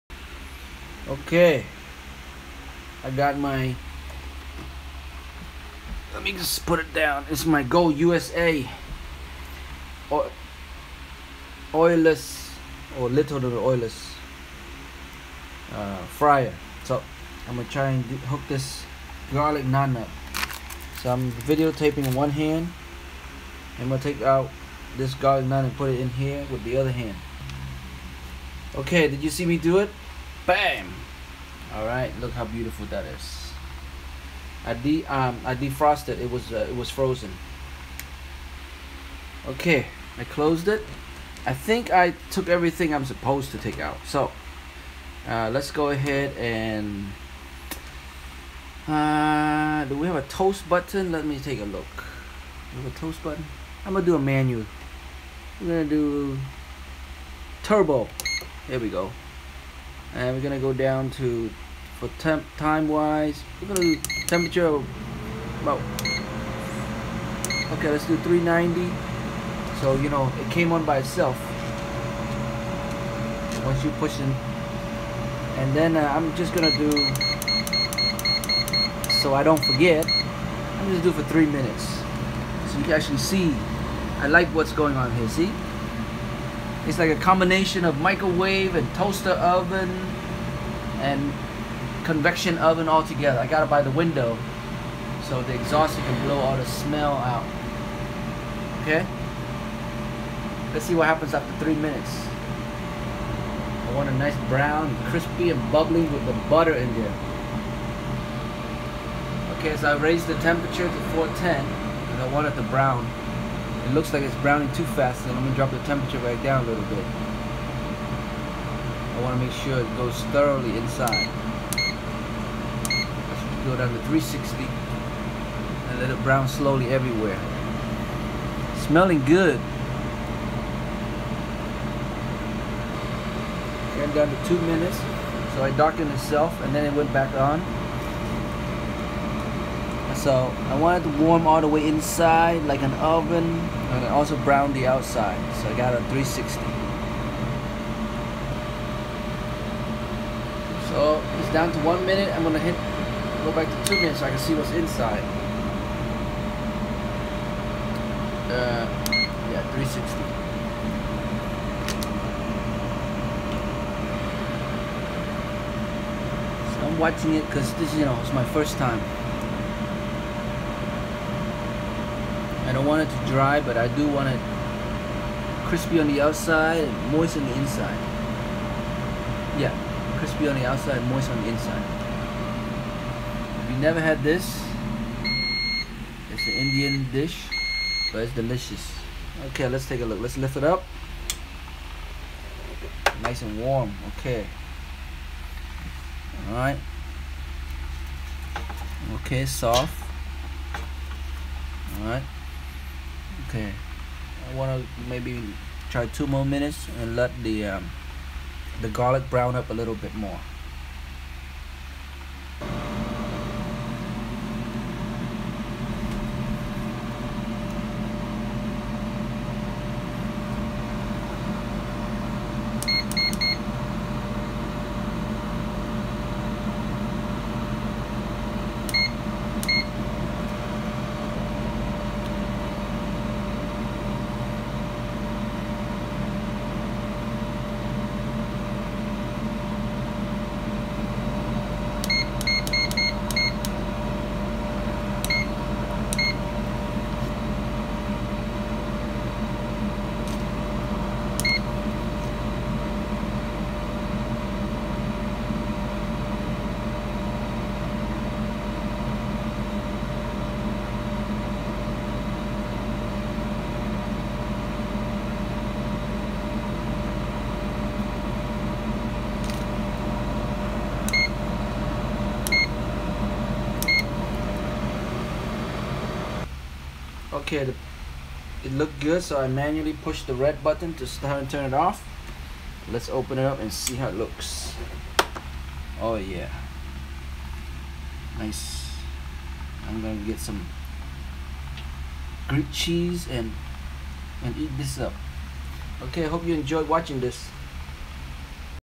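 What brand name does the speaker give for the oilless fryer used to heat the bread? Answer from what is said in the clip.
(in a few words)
Go USA.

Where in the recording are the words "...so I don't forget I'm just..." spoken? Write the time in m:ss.
1:19.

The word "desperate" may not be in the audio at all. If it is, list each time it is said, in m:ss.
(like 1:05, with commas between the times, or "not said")
not said.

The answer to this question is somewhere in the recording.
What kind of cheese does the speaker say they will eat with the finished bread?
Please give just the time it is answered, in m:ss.
4:52.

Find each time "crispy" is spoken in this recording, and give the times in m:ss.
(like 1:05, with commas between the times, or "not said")
1:45, 2:55, 3:00.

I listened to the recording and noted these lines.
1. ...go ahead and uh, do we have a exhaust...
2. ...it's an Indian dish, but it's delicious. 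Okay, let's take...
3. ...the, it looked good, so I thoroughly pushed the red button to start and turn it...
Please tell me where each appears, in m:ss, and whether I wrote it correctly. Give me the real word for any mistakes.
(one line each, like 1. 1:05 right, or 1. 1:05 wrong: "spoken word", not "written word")
1. 0:45 wrong: "toast", not "exhaust"
2. 3:06 right
3. 4:37 wrong: "manually", not "thoroughly".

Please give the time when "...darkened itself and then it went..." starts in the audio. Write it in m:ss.
2:15.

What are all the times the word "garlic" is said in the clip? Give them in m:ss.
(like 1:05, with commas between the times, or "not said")
0:19, 0:25, 3:28.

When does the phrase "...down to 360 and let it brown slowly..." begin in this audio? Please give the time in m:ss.
2:03.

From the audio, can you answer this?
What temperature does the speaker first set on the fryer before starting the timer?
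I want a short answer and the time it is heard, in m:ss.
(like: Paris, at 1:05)
390, at 1:08.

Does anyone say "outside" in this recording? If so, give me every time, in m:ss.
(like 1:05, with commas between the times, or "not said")
2:24, 2:56, 3:00.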